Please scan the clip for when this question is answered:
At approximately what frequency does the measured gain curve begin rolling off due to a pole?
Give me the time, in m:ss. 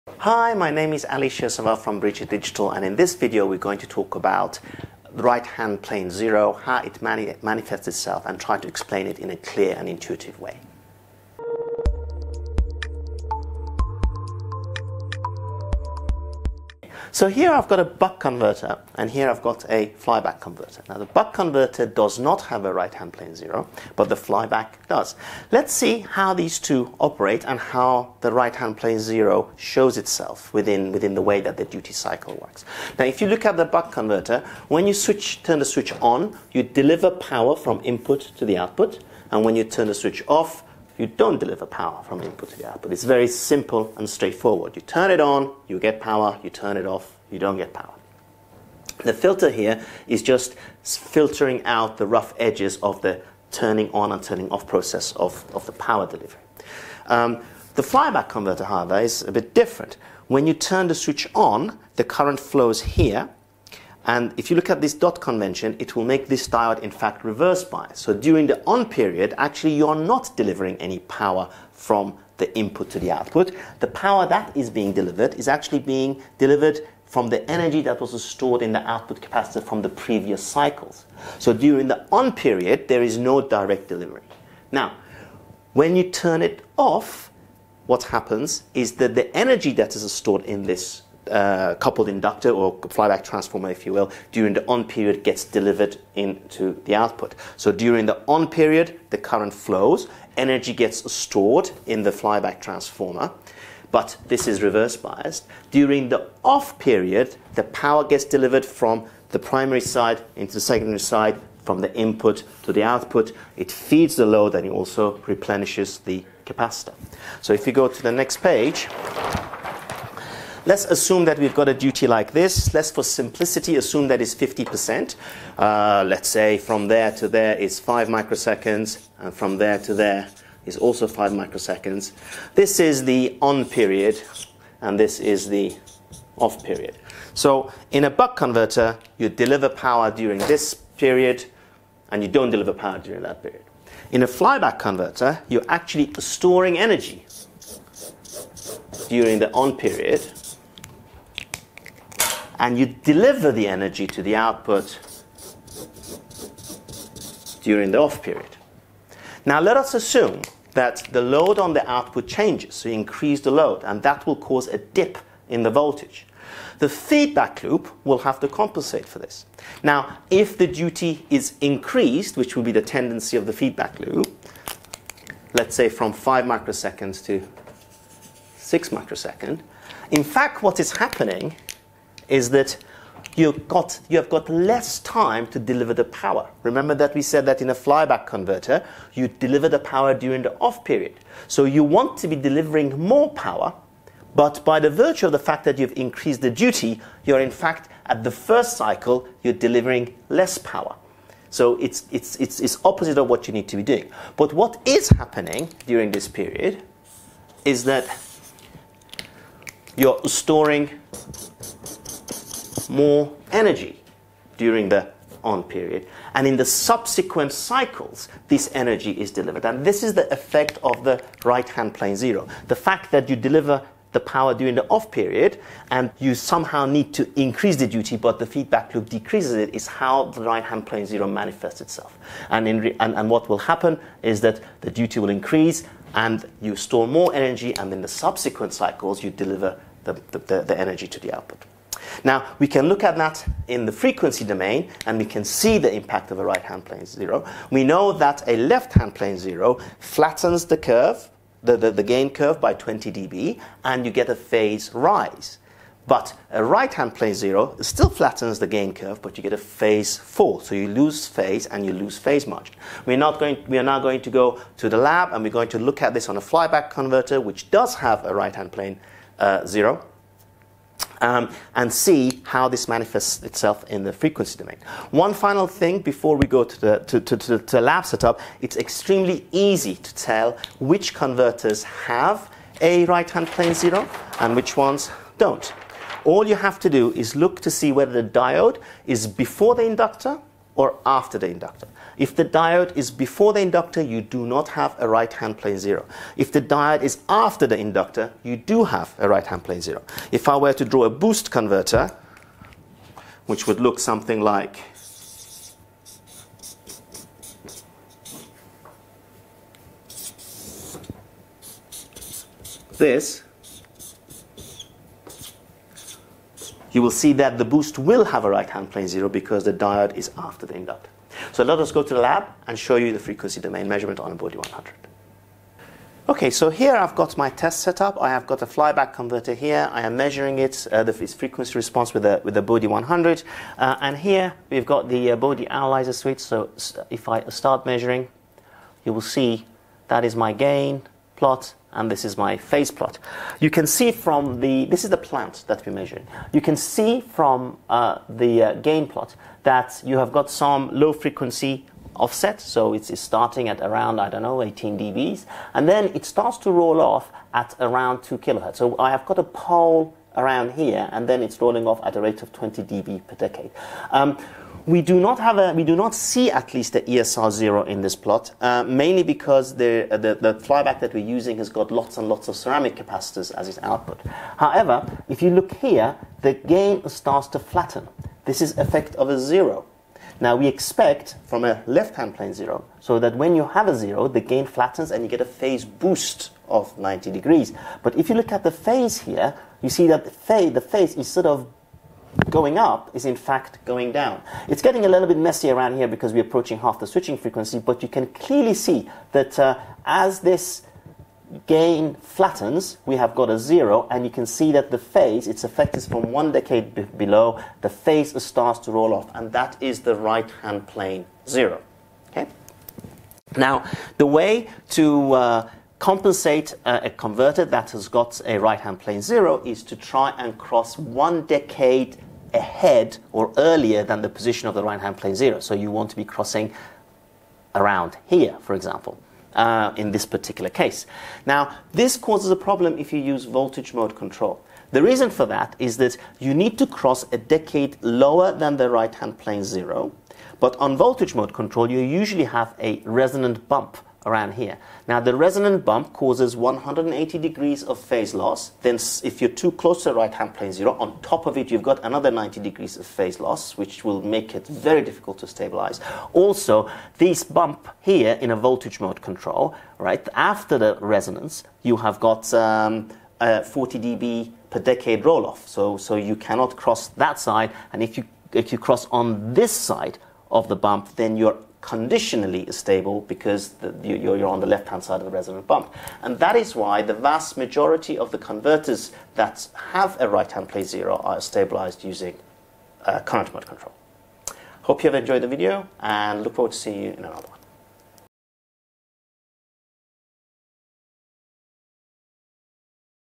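5:58.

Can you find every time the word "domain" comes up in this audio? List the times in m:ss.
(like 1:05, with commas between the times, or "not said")
4:04, 4:34, 5:23.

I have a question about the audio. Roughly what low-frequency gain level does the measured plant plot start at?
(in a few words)
18 dB.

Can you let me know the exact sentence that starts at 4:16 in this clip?
But a right-hand plane zero still flattens the gain curve, but you get a phase fall.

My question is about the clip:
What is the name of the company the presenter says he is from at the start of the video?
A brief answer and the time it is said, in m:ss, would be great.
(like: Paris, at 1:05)
Biricha Digital, at 0:01.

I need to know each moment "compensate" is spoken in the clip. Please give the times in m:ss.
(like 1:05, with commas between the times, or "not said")
2:48, 6:56.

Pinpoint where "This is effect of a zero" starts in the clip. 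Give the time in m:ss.
6:18.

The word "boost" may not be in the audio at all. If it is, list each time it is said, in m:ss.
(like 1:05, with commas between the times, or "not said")
5:01, 5:17, 6:25.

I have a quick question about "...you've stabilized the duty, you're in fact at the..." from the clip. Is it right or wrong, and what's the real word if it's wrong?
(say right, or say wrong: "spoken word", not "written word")
wrong: "increased", not "stabilized".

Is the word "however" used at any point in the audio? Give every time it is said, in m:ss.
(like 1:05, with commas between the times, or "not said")
0:58, 6:14.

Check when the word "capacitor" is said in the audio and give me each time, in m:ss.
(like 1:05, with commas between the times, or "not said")
1:19, 1:56, 6:12.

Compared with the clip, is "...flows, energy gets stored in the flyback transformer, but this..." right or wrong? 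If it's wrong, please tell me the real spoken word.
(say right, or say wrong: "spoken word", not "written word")
right.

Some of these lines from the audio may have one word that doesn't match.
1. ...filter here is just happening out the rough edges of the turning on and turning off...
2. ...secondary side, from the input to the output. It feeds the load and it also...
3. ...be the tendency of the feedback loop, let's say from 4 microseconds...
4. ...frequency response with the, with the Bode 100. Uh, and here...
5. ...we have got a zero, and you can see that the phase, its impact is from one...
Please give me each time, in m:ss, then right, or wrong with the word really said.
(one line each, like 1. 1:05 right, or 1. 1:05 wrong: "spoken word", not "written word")
1. 0:49 wrong: "filtering", not "happening"
2. 1:50 right
3. 2:52 wrong: "5", not "4"
4. 5:31 right
5. 6:43 wrong: "effect", not "impact".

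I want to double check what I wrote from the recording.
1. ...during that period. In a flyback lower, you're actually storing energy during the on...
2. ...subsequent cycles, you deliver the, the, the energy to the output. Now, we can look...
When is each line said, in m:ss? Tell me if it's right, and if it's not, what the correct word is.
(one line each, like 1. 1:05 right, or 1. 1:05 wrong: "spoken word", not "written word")
1. 2:22 wrong: "converter", not "lower"
2. 3:58 right.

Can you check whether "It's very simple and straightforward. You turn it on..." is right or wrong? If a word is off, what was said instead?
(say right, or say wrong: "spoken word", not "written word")
right.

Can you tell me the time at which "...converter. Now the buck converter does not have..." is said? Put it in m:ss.
0:20.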